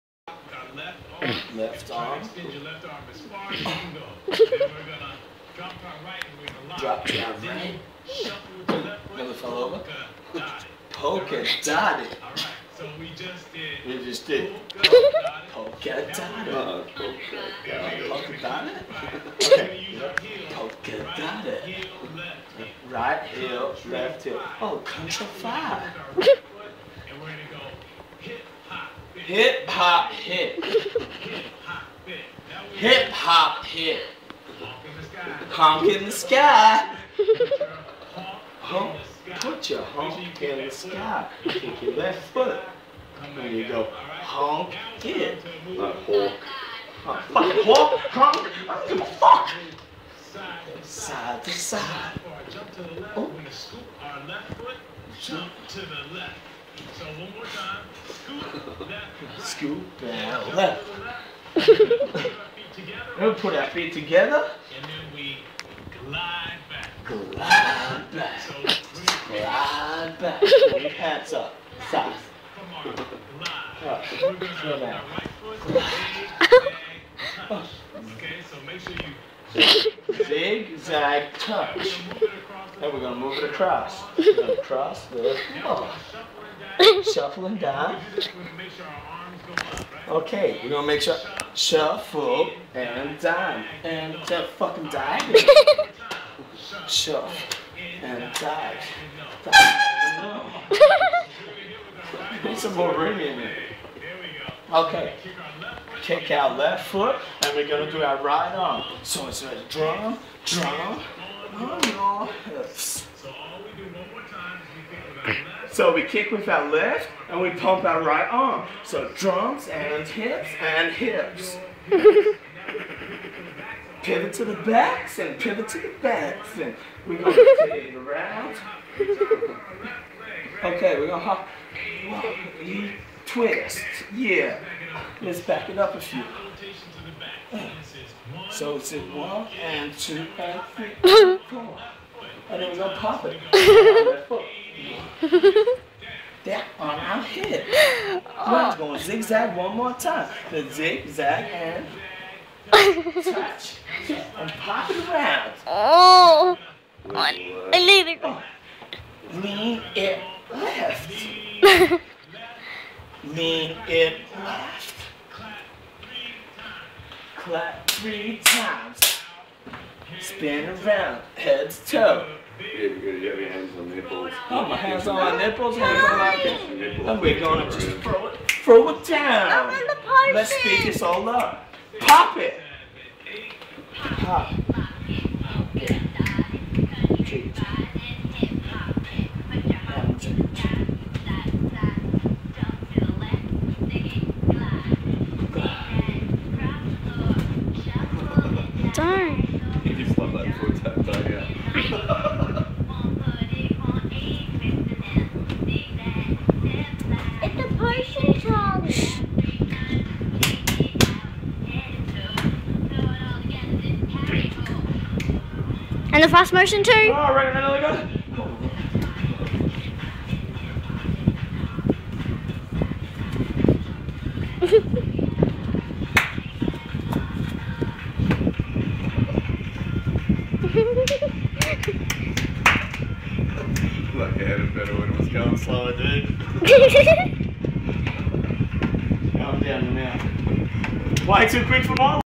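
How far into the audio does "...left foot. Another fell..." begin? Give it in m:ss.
0:08.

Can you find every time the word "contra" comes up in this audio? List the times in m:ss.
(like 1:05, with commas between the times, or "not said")
0:24.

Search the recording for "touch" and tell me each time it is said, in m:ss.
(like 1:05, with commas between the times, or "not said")
1:17, 1:21, 2:32.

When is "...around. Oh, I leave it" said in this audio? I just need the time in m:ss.
2:35.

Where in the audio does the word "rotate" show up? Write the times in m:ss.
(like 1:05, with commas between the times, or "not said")
2:07.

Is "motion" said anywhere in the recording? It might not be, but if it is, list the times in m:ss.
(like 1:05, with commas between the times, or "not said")
3:36.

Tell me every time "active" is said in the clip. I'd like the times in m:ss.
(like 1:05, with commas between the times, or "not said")
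not said.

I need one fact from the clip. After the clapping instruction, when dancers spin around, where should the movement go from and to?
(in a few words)
head to toe.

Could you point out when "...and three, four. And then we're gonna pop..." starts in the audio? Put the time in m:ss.
2:20.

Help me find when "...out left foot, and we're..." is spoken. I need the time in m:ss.
1:46.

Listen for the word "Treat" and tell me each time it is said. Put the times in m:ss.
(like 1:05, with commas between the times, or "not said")
3:07.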